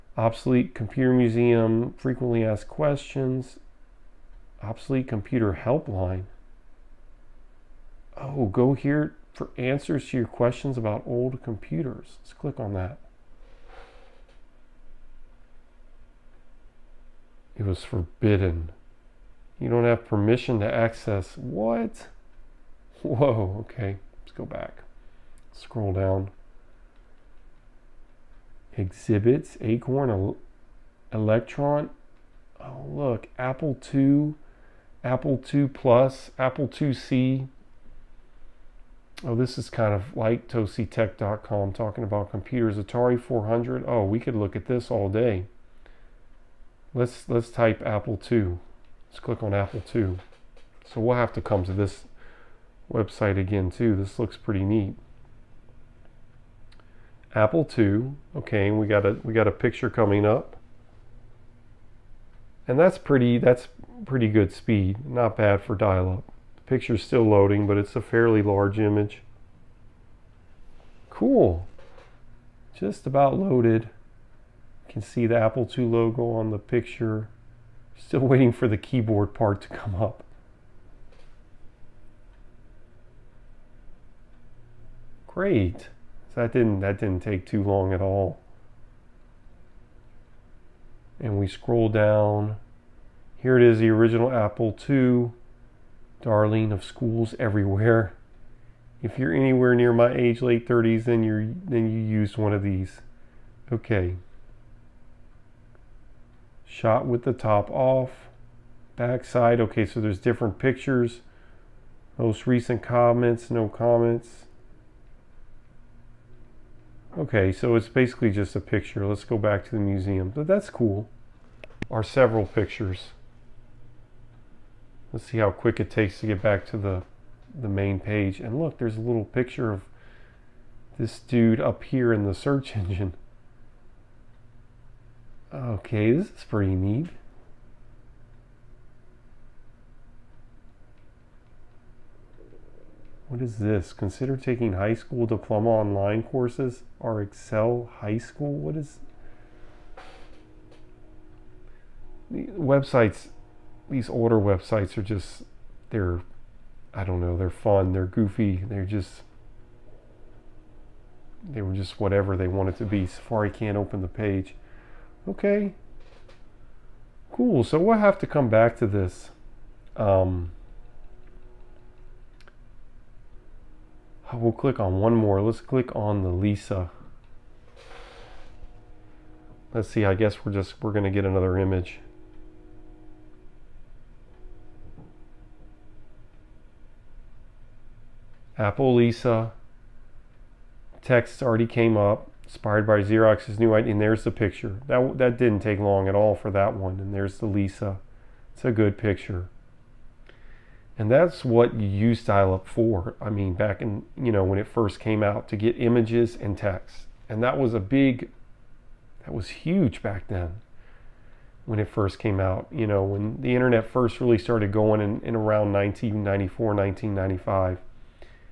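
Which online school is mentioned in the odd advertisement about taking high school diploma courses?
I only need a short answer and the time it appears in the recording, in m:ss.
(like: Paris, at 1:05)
Excel High School, at 2:27.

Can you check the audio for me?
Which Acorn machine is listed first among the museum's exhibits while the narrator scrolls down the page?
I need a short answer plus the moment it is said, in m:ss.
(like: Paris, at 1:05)
Electron, at 0:31.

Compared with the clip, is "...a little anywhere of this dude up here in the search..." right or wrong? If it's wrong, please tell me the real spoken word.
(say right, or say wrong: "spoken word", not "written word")
wrong: "picture", not "anywhere".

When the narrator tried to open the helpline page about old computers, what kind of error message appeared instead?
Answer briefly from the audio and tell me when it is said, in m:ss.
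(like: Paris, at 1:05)
Forbidden, at 0:17.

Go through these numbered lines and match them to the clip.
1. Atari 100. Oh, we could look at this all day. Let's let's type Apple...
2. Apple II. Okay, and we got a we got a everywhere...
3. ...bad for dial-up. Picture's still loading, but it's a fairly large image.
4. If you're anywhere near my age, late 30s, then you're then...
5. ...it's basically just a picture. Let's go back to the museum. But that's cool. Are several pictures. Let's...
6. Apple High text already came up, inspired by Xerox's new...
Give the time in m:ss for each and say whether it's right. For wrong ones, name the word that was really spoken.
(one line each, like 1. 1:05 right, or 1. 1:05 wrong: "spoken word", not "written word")
1. 0:42 wrong: "400", not "100"
2. 0:57 wrong: "picture", not "everywhere"
3. 1:05 right
4. 1:39 right
5. 1:57 right
6. 3:08 wrong: "Lisa", not "High".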